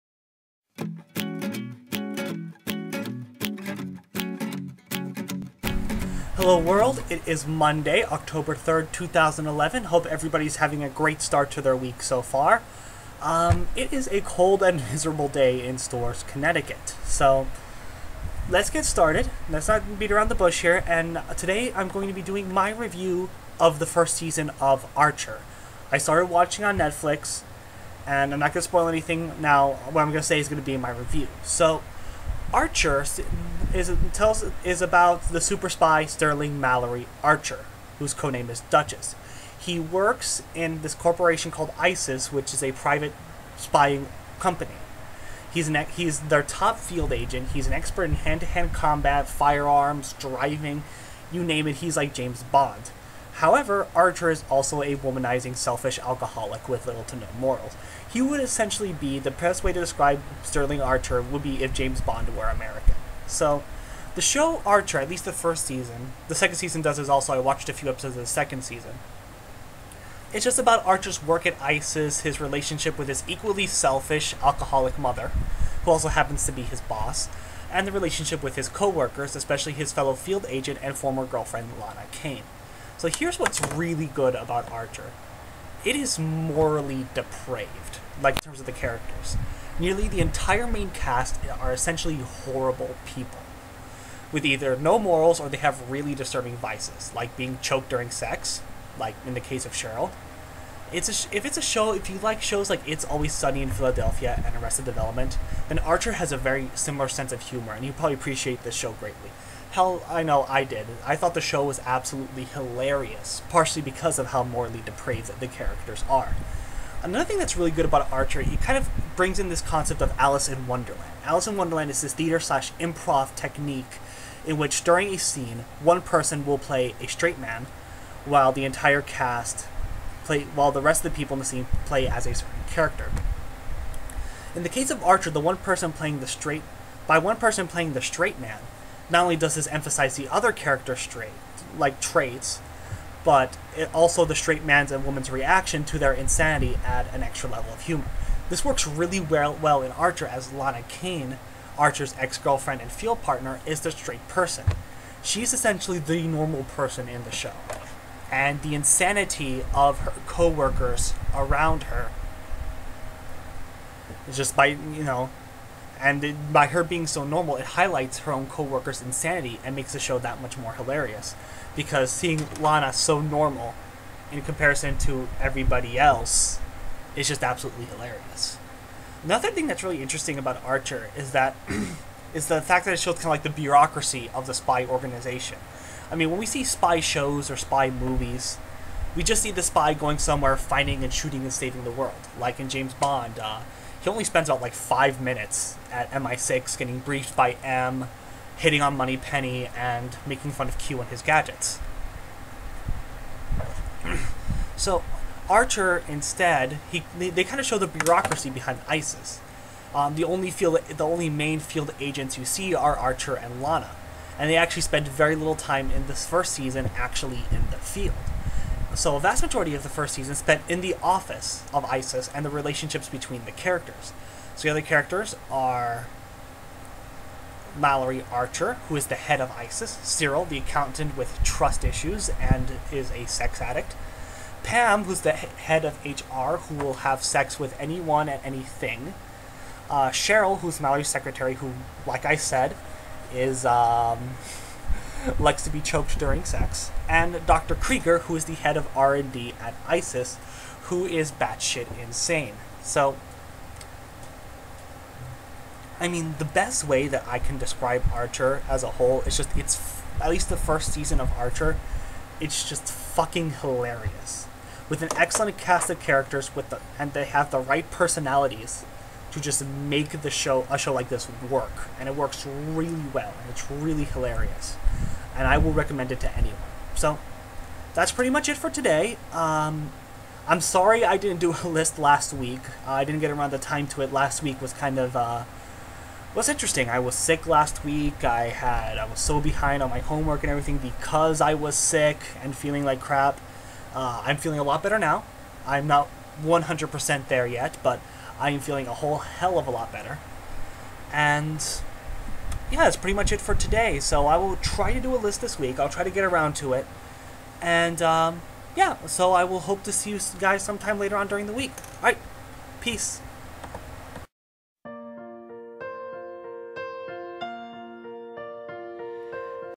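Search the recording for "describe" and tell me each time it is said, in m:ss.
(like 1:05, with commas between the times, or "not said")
0:59, 4:17.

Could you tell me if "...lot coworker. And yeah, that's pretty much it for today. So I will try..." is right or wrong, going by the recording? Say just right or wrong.
wrong.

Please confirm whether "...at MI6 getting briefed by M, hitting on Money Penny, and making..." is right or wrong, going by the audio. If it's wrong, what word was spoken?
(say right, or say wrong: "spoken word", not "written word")
right.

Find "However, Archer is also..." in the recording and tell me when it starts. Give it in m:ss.
0:53.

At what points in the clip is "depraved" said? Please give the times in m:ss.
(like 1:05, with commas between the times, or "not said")
1:27, 1:54.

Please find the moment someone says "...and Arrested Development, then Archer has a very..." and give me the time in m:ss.
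1:44.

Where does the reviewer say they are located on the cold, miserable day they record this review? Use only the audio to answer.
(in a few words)
Storrs, Connecticut.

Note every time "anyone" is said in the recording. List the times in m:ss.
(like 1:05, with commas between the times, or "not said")
3:57, 4:36.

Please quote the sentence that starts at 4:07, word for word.
Krieger, who is the head of R&D at ISIS, who is batshit insane.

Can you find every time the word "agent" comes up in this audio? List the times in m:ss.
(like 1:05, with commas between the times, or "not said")
0:47, 1:20, 3:31.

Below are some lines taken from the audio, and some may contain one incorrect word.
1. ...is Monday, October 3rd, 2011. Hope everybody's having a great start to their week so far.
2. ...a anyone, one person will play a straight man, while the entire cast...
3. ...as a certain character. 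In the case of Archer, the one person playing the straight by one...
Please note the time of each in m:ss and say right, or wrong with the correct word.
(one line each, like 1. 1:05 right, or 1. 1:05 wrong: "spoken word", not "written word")
1. 0:07 right
2. 2:05 wrong: "scene", not "anyone"
3. 2:12 right.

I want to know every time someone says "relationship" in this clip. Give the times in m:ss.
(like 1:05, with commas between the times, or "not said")
1:12, 1:17, 3:42.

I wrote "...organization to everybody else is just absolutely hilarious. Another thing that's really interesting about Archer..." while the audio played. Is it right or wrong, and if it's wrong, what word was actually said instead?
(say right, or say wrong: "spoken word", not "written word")
wrong: "comparison", not "organization".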